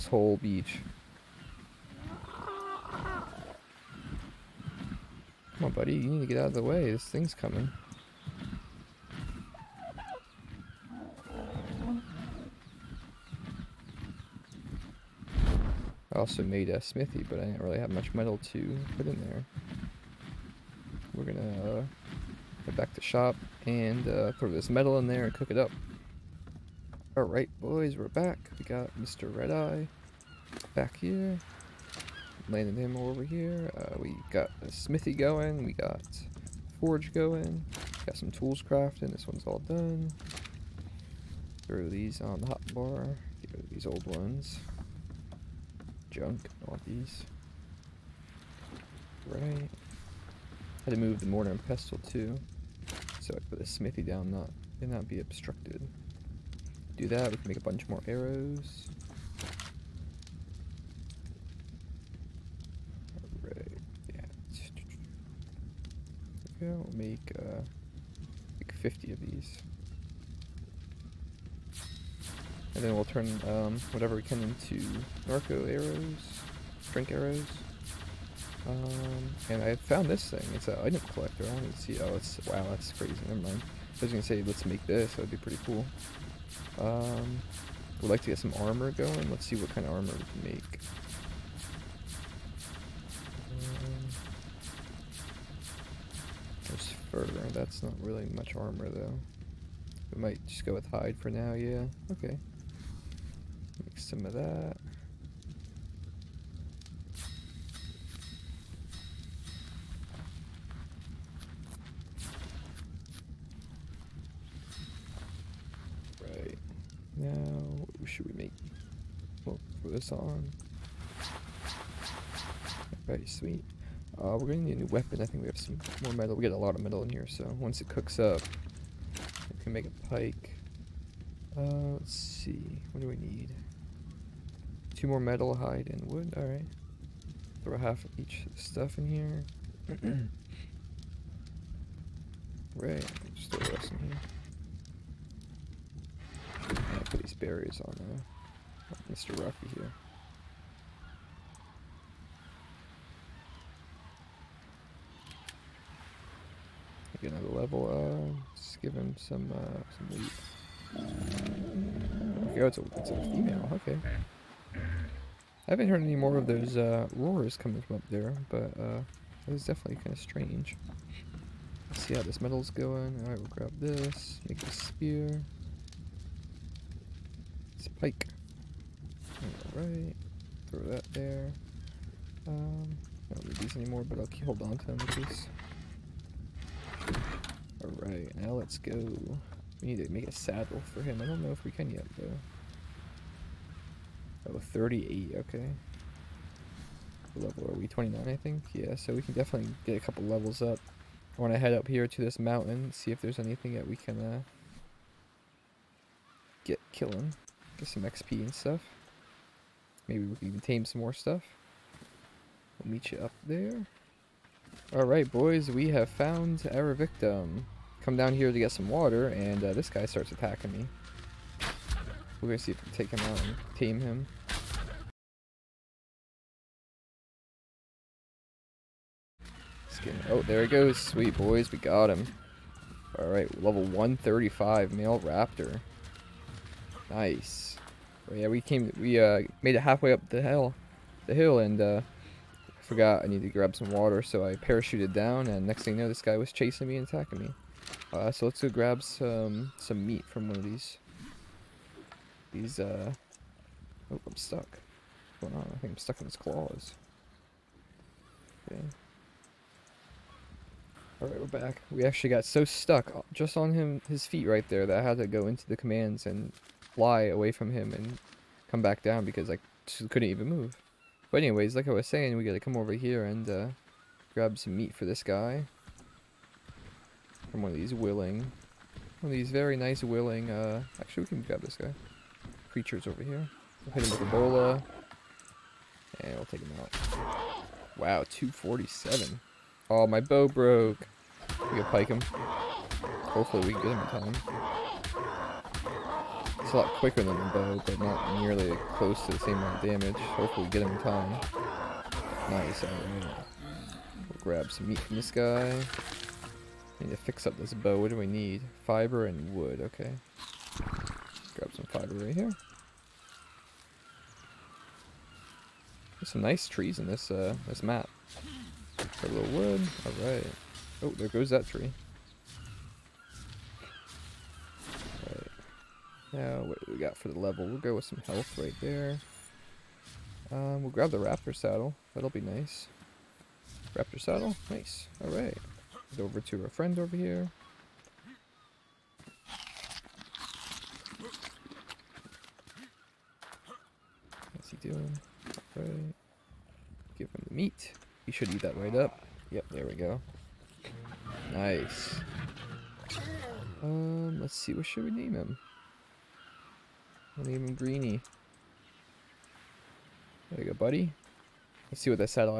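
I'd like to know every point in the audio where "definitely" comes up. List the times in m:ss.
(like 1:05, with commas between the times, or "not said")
2:49, 3:19.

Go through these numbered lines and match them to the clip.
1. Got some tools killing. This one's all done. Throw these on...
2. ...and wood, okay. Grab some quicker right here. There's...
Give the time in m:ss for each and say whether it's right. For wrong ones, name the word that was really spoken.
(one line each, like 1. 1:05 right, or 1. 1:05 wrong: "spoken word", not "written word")
1. 0:38 wrong: "crafting", not "killing"
2. 5:09 wrong: "fiber", not "quicker".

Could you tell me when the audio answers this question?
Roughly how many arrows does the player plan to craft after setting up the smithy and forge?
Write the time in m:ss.
1:08.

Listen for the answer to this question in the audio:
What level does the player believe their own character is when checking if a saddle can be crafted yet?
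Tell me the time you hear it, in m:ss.
3:17.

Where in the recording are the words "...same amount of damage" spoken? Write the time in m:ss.
4:59.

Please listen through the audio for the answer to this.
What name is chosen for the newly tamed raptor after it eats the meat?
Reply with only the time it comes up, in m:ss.
5:57.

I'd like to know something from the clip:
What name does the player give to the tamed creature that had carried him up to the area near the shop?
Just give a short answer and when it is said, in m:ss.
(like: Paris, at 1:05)
Mr. Red Eye, at 0:28.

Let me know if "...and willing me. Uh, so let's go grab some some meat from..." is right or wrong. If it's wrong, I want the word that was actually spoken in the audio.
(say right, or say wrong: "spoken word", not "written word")
wrong: "attacking", not "willing".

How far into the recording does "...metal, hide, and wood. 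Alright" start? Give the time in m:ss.
2:15.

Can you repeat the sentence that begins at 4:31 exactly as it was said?
But anyways, like I was saying, we gotta come over here and uh, grab some meat for this guy.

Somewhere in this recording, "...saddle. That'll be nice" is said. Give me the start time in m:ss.
5:31.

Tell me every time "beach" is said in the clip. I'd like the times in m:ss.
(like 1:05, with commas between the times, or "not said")
0:00.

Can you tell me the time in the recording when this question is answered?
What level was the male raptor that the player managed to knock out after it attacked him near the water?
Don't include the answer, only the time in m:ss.
3:53.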